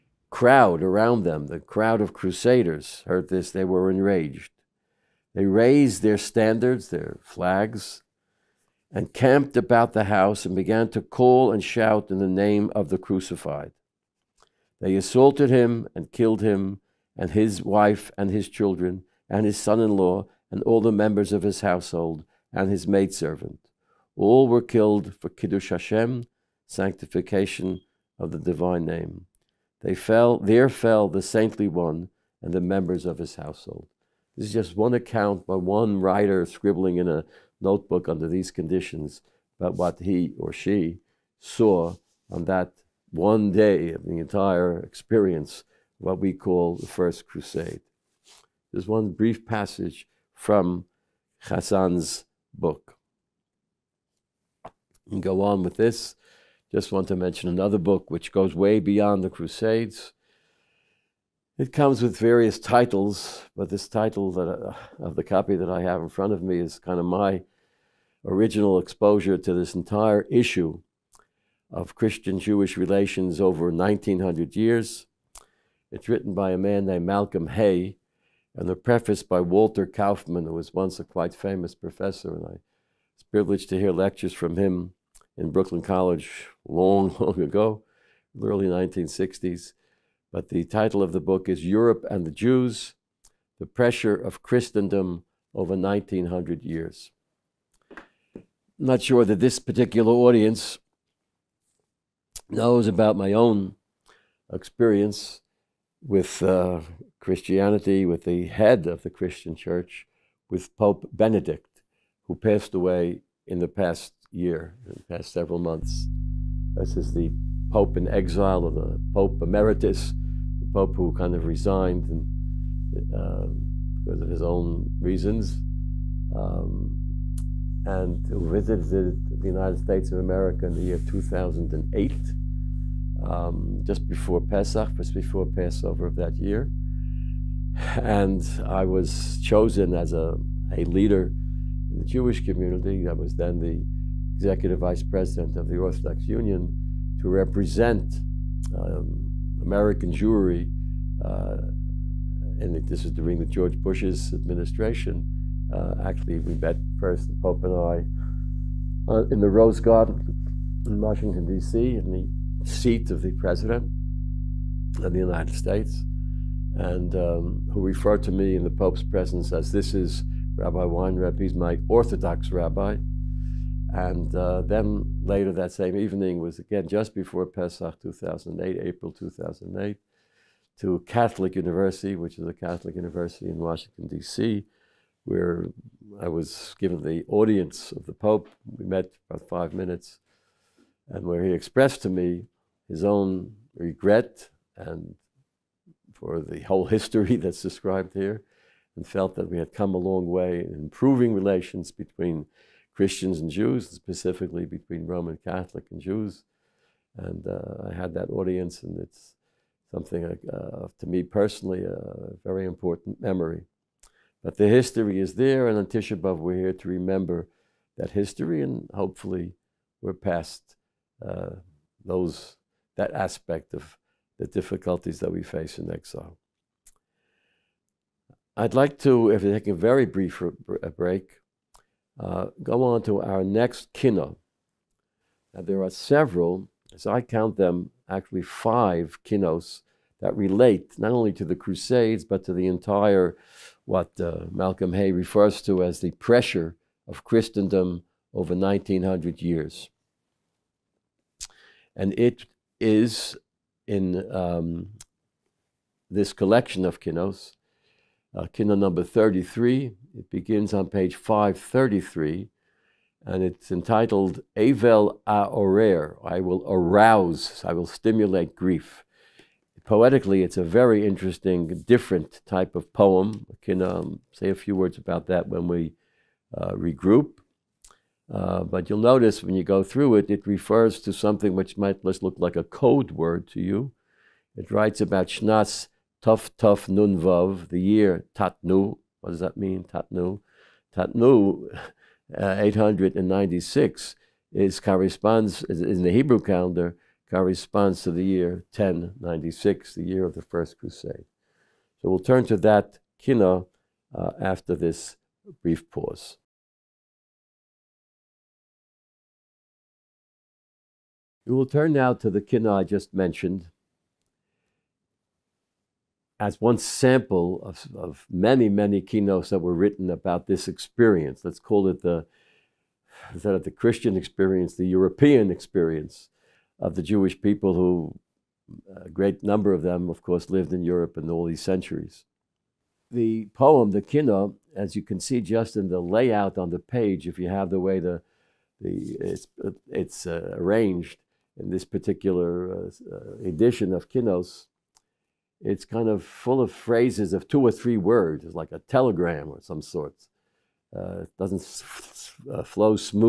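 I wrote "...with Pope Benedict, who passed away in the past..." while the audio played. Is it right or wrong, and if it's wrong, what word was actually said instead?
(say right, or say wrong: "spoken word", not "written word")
right.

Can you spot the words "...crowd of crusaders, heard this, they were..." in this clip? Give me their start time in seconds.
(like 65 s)
1 s.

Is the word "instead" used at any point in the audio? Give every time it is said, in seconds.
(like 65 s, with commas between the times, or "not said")
323 s.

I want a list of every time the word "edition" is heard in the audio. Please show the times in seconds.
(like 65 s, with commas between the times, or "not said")
343 s.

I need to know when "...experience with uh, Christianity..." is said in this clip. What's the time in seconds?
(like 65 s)
104 s.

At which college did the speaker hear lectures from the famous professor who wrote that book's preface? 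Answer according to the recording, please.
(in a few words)
Brooklyn College.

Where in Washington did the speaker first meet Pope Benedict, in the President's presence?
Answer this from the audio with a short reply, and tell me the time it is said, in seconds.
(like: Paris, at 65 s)
Rose Garden, at 159 s.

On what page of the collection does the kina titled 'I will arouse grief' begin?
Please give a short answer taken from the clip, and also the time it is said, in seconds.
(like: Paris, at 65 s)
533, at 260 s.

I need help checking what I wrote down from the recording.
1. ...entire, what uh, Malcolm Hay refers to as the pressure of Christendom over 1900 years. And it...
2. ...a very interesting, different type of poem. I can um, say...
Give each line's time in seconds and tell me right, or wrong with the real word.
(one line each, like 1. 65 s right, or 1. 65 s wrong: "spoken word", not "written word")
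1. 242 s right
2. 270 s right.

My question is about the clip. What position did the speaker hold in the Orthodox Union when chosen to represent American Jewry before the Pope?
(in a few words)
executive vice president.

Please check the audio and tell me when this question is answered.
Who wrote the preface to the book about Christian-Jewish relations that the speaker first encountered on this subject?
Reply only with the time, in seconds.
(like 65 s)
79 s.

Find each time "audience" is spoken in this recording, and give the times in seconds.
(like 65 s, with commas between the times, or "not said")
100 s, 187 s, 208 s.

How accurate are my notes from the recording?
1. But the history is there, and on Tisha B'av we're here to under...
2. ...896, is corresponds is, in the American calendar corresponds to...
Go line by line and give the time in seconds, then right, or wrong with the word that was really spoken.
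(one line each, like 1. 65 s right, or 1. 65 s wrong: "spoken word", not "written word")
1. 214 s wrong: "remember", not "under"
2. 292 s wrong: "Hebrew", not "American".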